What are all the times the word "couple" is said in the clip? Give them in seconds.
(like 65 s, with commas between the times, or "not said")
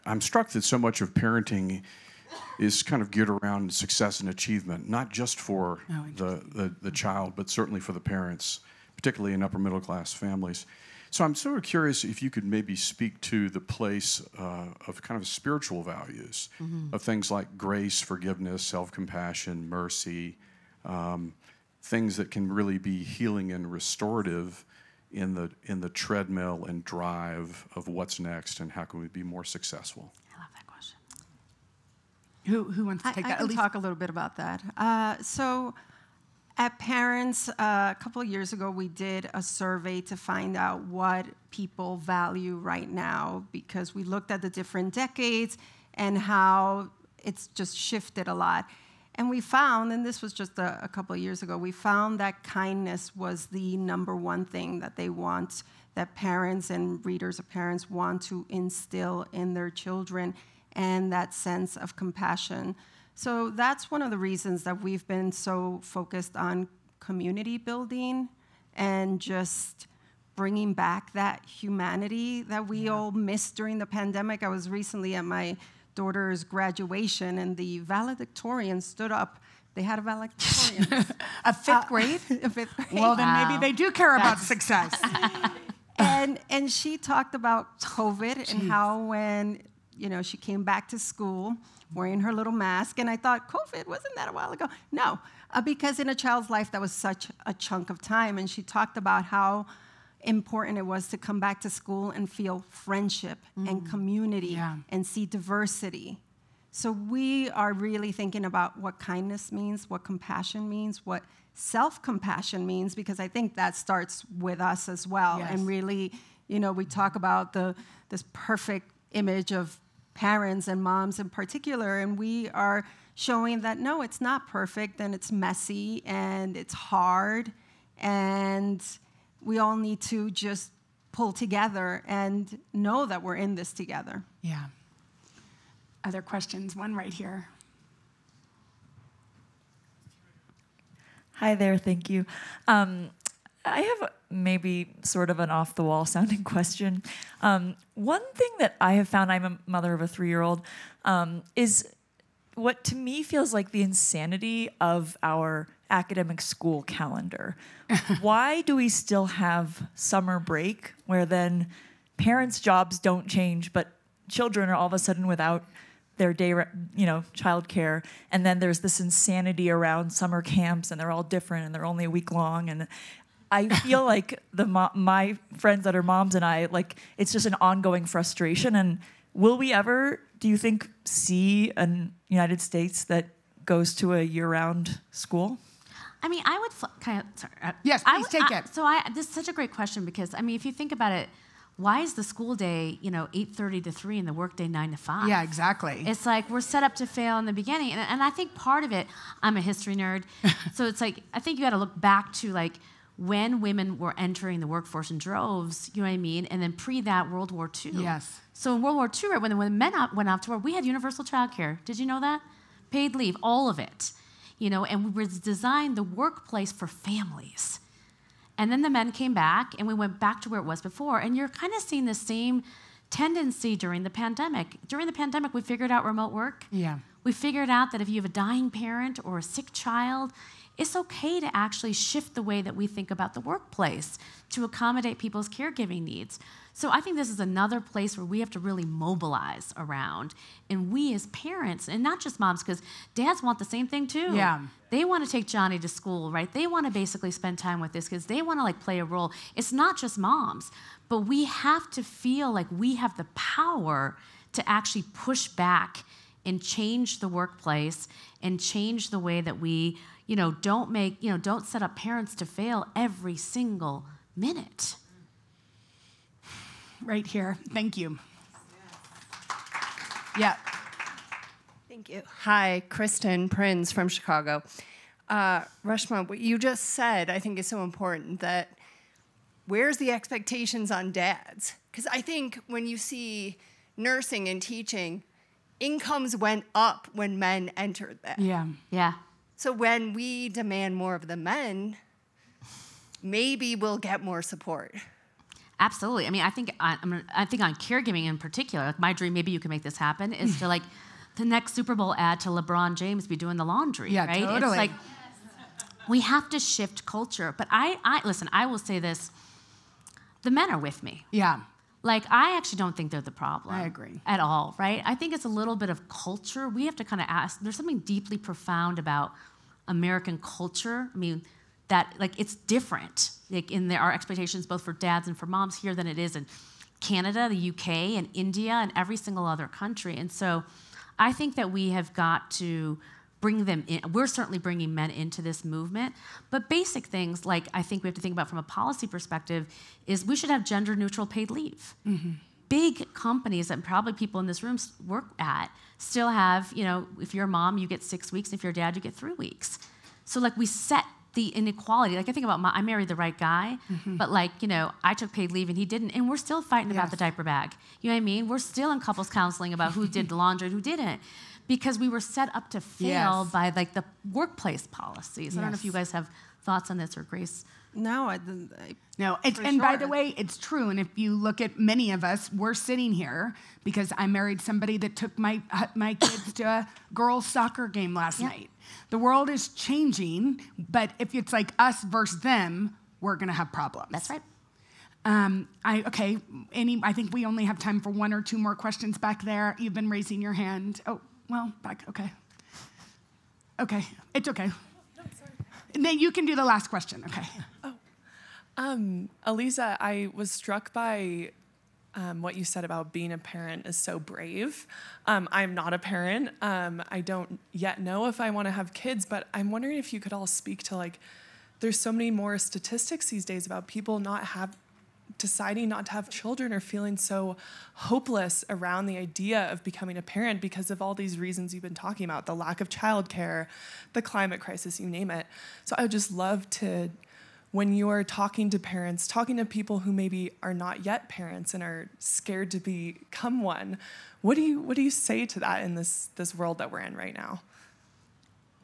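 38 s, 50 s, 358 s.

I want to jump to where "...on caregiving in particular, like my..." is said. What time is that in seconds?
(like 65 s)
297 s.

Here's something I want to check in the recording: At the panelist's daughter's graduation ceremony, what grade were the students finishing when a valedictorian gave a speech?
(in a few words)
fifth grade.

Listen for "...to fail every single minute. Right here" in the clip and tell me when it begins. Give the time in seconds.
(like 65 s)
262 s.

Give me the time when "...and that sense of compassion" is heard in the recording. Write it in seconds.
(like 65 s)
60 s.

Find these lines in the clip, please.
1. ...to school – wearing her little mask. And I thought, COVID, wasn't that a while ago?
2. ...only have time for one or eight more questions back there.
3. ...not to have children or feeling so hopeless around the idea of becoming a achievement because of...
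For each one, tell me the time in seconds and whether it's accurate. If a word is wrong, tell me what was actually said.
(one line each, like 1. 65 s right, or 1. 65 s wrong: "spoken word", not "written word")
1. 90 s right
2. 387 s wrong: "two", not "eight"
3. 415 s wrong: "parent", not "achievement".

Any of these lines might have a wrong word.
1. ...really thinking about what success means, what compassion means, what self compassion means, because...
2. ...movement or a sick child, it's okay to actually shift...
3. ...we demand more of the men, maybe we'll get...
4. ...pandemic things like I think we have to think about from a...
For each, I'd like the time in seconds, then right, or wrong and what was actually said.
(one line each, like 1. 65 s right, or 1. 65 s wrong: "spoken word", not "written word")
1. 107 s wrong: "kindness", not "success"
2. 228 s wrong: "parent", not "movement"
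3. 290 s right
4. 336 s wrong: "basic", not "pandemic".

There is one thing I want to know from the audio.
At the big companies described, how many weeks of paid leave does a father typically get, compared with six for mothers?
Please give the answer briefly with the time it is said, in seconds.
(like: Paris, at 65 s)
3, at 349 s.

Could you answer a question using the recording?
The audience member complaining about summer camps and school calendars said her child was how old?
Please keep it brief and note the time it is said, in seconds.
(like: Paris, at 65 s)
3, at 150 s.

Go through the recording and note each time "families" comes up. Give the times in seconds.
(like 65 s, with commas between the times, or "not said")
10 s, 216 s.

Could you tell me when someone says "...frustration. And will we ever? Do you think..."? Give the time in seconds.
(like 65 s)
178 s.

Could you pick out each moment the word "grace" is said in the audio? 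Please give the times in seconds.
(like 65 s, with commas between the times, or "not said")
17 s, 367 s.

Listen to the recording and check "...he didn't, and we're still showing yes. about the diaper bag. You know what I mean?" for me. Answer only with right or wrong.
wrong.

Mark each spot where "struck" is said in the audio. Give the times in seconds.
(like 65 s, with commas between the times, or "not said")
0 s, 400 s.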